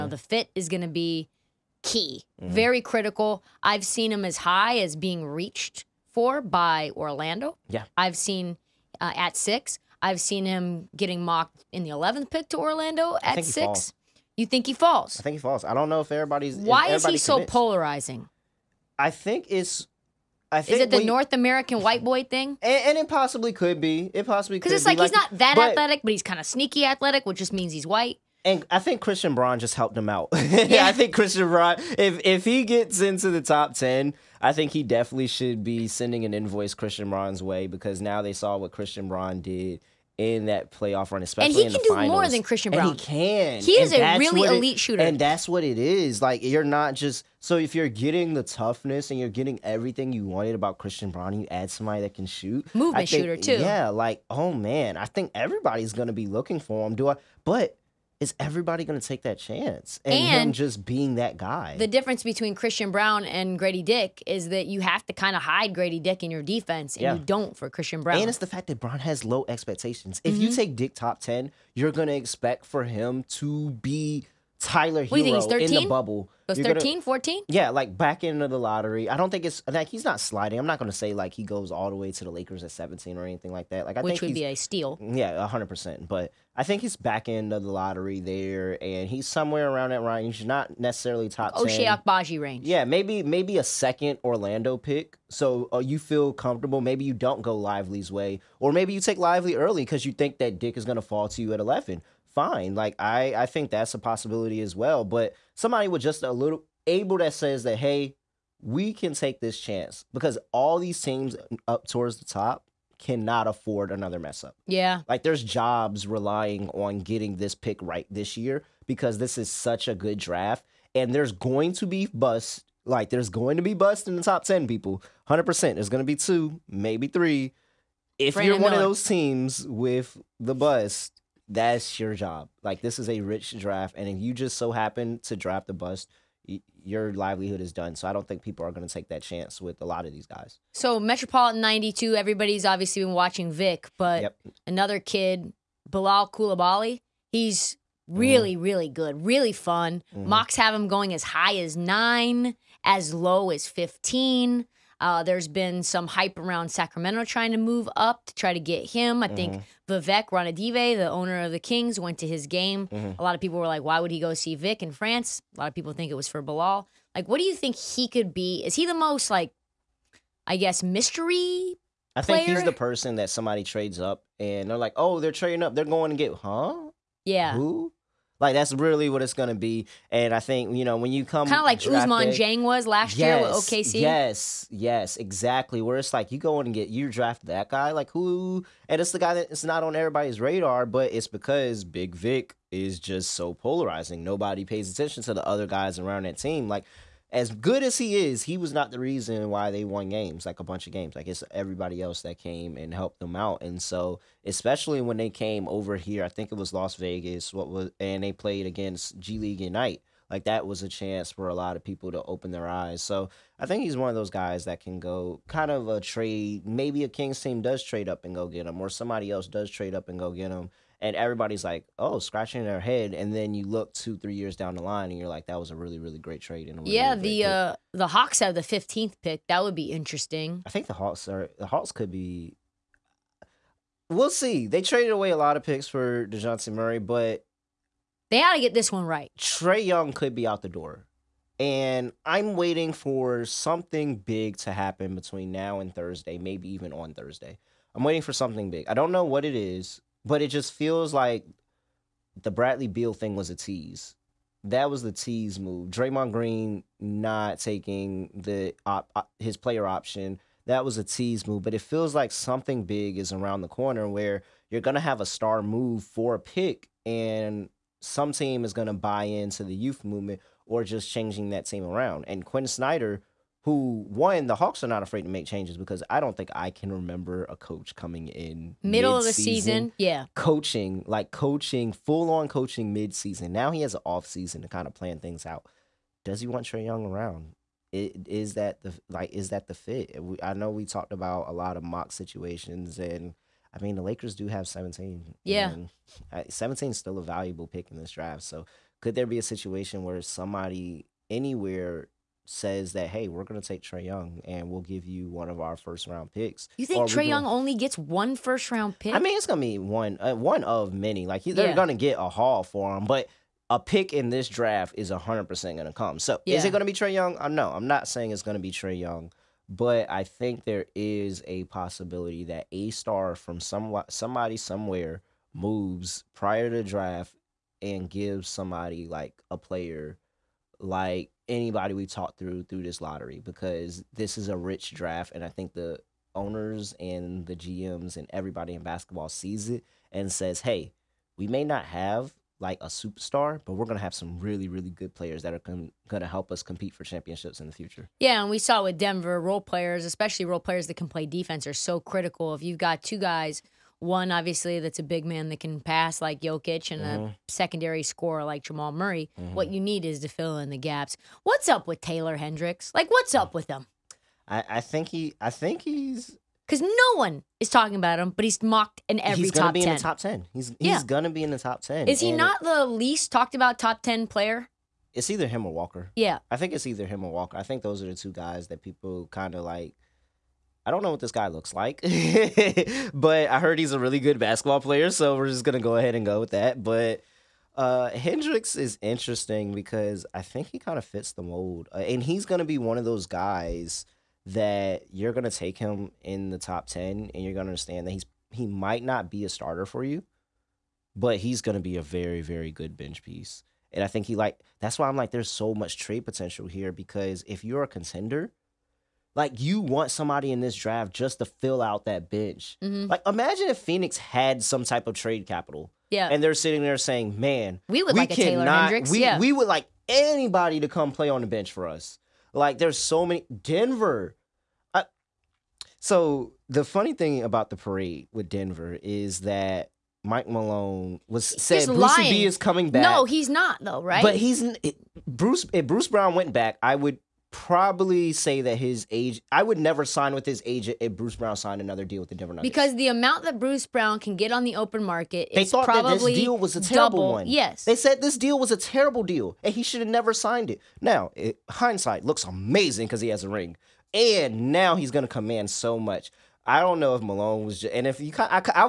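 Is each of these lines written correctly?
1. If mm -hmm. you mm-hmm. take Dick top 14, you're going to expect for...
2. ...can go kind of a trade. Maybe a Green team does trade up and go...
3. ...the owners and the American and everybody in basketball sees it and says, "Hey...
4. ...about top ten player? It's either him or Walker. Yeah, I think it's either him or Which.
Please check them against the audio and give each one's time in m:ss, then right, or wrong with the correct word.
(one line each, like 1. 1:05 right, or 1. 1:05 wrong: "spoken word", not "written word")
1. 1:10 wrong: "10", not "14"
2. 3:34 wrong: "Kings", not "Green"
3. 5:35 wrong: "GMs", not "American"
4. 6:13 wrong: "Walker", not "Which".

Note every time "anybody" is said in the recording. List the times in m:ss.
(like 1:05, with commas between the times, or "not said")
5:31, 7:00.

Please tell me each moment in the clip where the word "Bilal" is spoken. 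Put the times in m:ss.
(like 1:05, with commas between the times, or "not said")
2:25, 2:46.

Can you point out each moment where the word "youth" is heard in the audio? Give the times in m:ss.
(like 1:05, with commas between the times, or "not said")
4:29.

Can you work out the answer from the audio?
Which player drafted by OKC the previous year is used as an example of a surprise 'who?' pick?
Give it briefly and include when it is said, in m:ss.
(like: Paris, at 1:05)
Ousmane Dieng, at 3:01.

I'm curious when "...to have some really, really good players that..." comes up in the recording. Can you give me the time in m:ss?
5:43.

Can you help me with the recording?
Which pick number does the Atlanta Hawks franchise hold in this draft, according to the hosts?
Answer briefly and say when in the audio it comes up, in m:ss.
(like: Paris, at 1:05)
15, at 3:48.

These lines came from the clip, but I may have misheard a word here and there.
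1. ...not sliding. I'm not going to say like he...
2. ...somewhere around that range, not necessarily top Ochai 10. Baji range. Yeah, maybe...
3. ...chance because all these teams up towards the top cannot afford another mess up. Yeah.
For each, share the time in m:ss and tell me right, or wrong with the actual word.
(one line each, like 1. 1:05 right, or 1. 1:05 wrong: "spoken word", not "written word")
1. 1:20 right
2. 1:29 right
3. 1:49 right.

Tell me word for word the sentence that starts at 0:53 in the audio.
Yeah, like oh man, I think everybody's gonna be looking for him.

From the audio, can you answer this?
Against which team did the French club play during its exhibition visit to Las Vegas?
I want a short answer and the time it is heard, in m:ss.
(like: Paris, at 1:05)
G League Ignite, at 3:29.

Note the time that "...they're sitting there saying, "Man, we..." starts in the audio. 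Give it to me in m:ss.
6:56.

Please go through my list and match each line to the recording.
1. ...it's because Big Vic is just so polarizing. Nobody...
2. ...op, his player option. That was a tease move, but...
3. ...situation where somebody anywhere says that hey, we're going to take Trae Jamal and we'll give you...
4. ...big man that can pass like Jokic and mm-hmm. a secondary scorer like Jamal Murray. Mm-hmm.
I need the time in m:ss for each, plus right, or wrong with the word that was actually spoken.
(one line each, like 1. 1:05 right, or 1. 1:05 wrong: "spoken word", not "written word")
1. 3:11 right
2. 4:18 right
3. 4:59 wrong: "Young", not "Jamal"
4. 5:55 right.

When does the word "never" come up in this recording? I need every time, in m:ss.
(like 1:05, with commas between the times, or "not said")
7:19, 7:30.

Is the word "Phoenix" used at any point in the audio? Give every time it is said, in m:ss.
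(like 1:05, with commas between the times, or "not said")
6:53.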